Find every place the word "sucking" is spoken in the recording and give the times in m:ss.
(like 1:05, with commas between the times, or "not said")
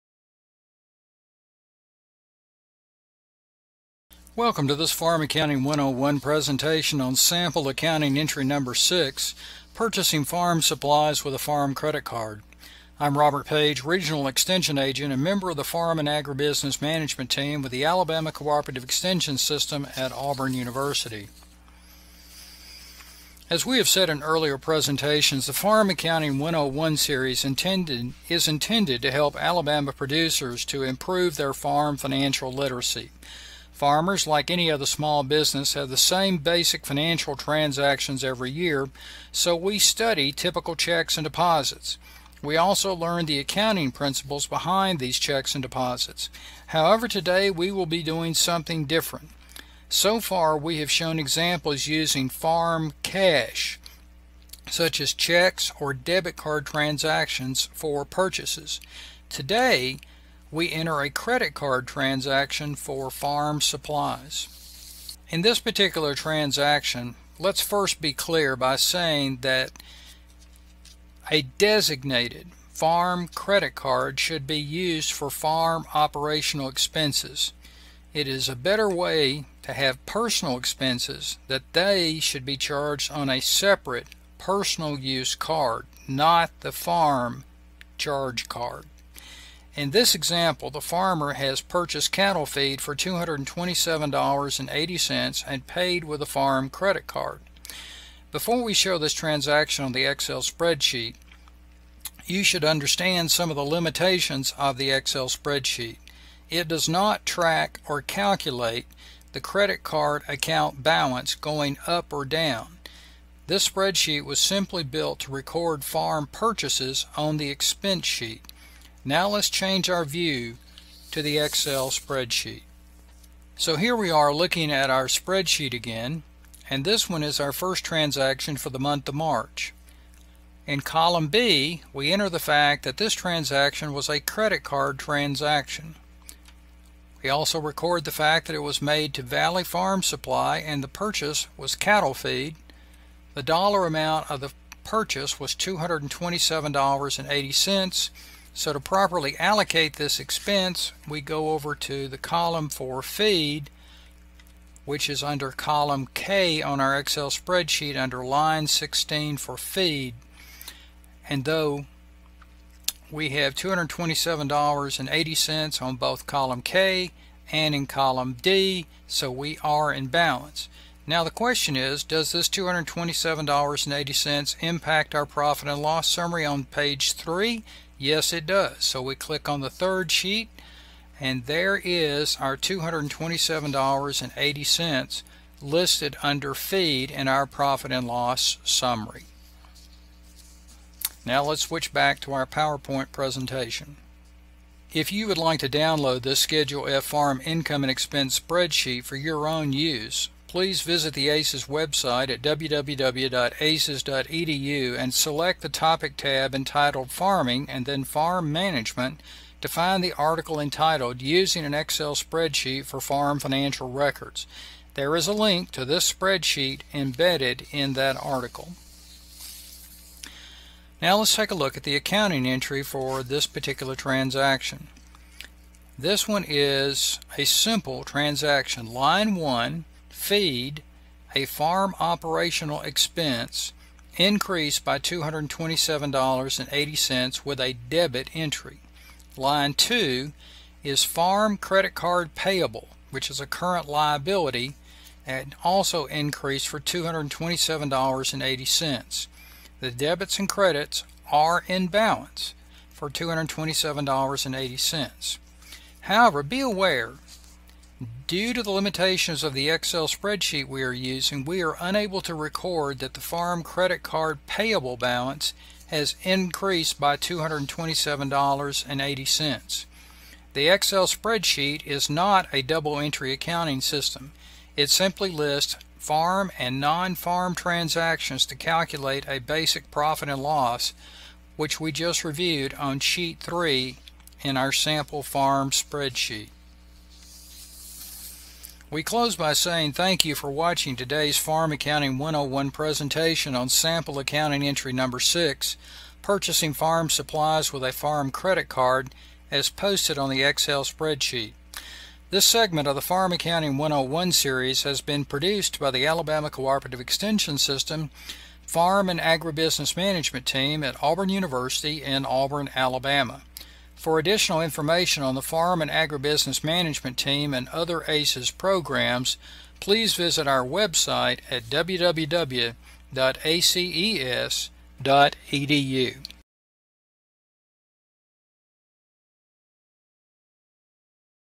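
not said.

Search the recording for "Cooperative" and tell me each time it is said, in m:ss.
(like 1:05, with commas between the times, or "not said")
0:18, 5:06.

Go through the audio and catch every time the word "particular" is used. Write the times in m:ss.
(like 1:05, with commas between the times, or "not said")
1:05, 3:43.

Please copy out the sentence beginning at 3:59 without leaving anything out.
Line 2 is farm credit card payable, which is a current liability and also increased for $227.80.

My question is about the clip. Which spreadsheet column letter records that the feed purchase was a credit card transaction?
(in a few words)
B.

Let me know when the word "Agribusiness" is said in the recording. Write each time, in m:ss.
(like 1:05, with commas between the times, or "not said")
0:16, 5:09, 5:15.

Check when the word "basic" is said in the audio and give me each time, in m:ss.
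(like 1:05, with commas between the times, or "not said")
0:36, 4:39.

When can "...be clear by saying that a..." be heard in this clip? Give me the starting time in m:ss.
1:08.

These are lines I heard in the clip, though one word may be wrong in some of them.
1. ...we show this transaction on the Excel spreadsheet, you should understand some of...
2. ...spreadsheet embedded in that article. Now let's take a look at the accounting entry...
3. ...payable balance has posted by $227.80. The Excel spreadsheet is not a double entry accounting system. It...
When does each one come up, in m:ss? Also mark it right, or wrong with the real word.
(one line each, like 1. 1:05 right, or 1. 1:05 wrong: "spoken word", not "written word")
1. 1:38 right
2. 3:36 right
3. 4:24 wrong: "increased", not "posted".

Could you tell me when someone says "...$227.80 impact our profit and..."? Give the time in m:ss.
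2:52.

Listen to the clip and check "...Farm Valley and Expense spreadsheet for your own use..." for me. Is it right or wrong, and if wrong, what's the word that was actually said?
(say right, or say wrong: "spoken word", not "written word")
wrong: "Income", not "Valley".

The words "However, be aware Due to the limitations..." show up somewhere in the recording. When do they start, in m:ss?
4:16.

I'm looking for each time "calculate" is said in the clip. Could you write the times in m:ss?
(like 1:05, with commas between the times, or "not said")
1:48, 4:38.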